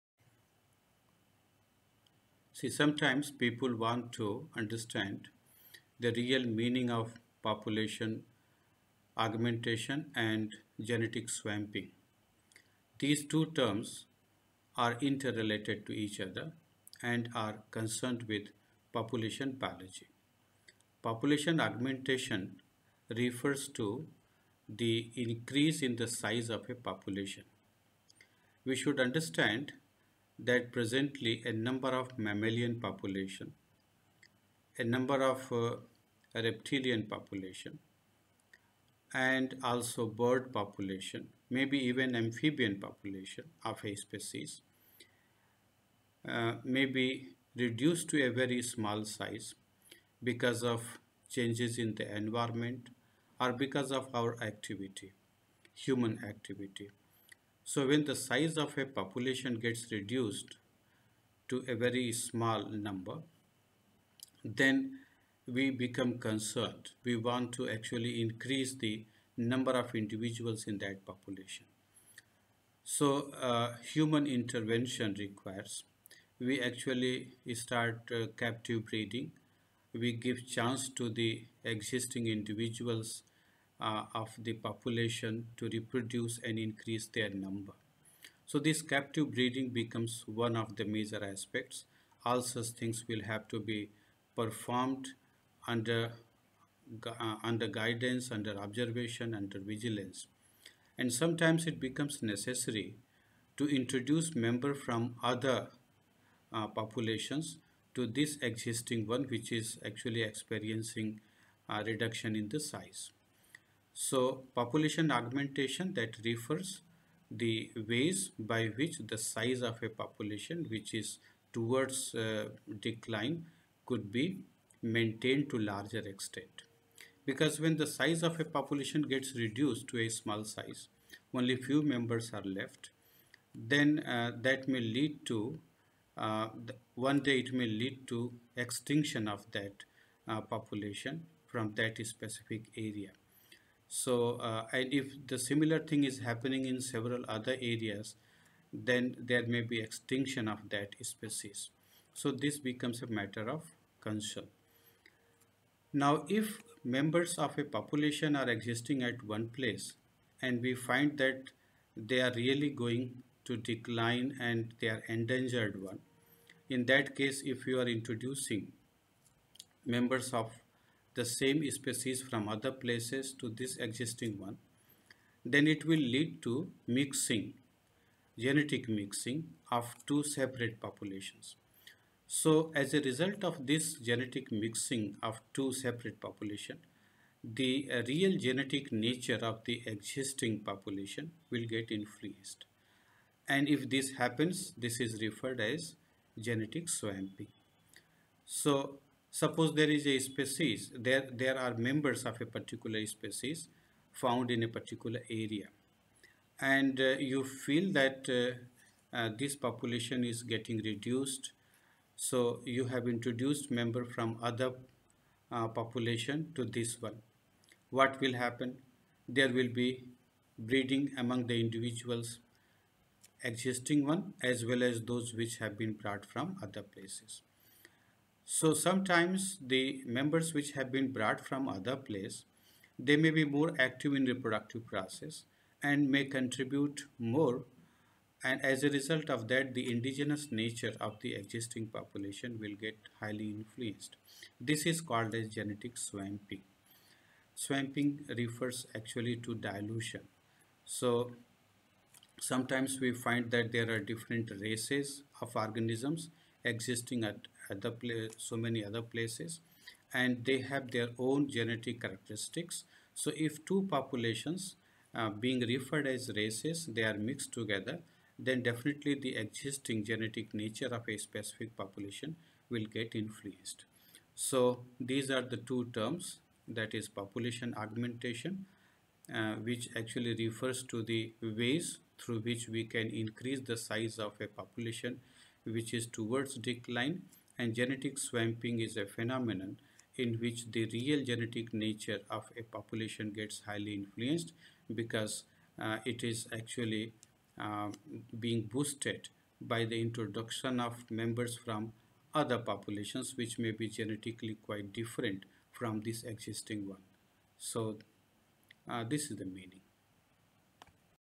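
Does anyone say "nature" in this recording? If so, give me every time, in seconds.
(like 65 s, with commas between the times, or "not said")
188 s, 240 s, 270 s, 291 s.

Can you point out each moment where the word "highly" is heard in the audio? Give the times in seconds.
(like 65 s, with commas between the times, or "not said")
243 s, 293 s.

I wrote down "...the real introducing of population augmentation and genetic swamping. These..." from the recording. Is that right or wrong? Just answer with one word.
wrong.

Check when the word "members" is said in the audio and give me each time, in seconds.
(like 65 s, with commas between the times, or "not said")
104 s, 131 s, 156 s, 169 s, 201 s, 213 s, 230 s, 301 s.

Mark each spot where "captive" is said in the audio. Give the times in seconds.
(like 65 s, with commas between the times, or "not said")
78 s, 88 s.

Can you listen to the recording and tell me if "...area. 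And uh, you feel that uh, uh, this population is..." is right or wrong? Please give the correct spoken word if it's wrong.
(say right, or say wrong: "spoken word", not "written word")
right.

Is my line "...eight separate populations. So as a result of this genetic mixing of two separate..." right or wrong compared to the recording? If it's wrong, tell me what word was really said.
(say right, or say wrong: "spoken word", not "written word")
wrong: "two", not "eight".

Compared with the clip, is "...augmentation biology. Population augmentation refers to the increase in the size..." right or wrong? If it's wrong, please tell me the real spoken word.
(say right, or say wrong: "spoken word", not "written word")
wrong: "population", not "augmentation".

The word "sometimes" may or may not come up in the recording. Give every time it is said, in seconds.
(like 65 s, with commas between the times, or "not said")
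2 s, 101 s, 228 s, 252 s.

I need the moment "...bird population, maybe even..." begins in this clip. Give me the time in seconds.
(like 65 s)
40 s.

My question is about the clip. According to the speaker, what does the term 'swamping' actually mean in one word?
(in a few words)
Dilution.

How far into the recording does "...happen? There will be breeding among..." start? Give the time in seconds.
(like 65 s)
218 s.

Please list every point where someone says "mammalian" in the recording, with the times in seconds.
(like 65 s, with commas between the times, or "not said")
32 s.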